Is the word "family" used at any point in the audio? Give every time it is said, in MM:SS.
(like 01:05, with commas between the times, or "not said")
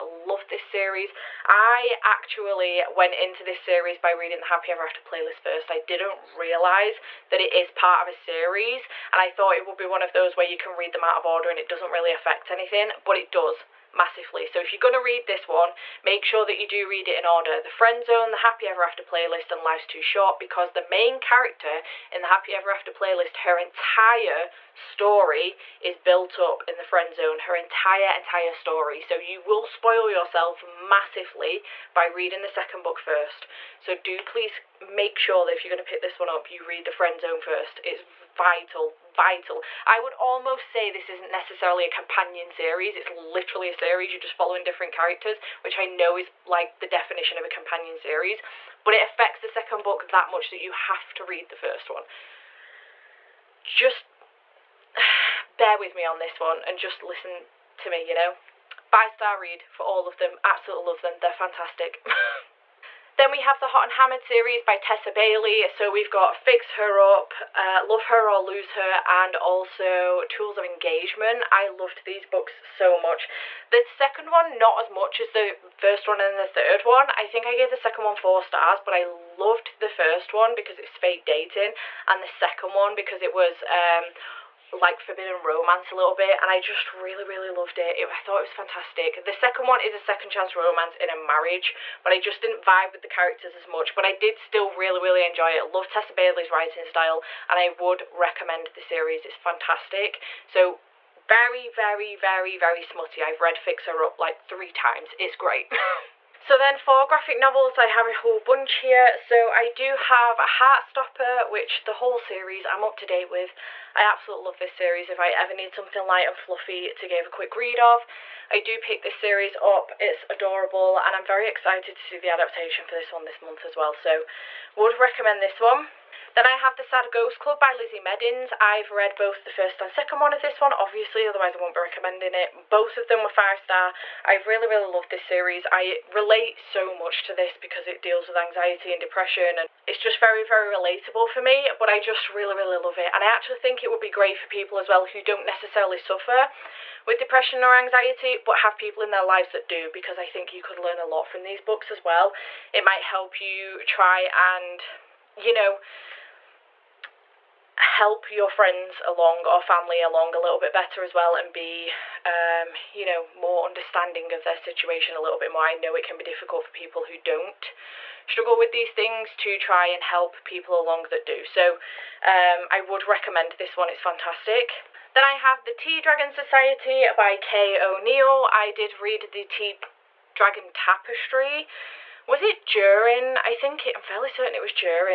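02:39.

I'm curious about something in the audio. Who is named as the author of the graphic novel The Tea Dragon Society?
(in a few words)
Kay O'Neill.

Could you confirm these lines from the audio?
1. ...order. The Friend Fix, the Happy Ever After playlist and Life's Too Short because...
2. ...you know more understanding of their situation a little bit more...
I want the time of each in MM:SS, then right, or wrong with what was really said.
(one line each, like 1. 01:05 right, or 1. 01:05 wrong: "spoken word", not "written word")
1. 00:17 wrong: "Zone", not "Fix"
2. 02:42 right.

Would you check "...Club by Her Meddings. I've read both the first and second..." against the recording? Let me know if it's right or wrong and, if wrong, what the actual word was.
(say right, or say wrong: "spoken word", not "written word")
wrong: "Lizzie", not "Her".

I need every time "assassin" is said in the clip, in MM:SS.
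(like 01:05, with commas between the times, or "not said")
not said.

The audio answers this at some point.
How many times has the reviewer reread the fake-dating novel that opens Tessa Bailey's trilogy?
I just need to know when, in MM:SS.
01:44.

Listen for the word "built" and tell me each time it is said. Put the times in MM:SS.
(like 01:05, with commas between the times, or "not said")
00:25.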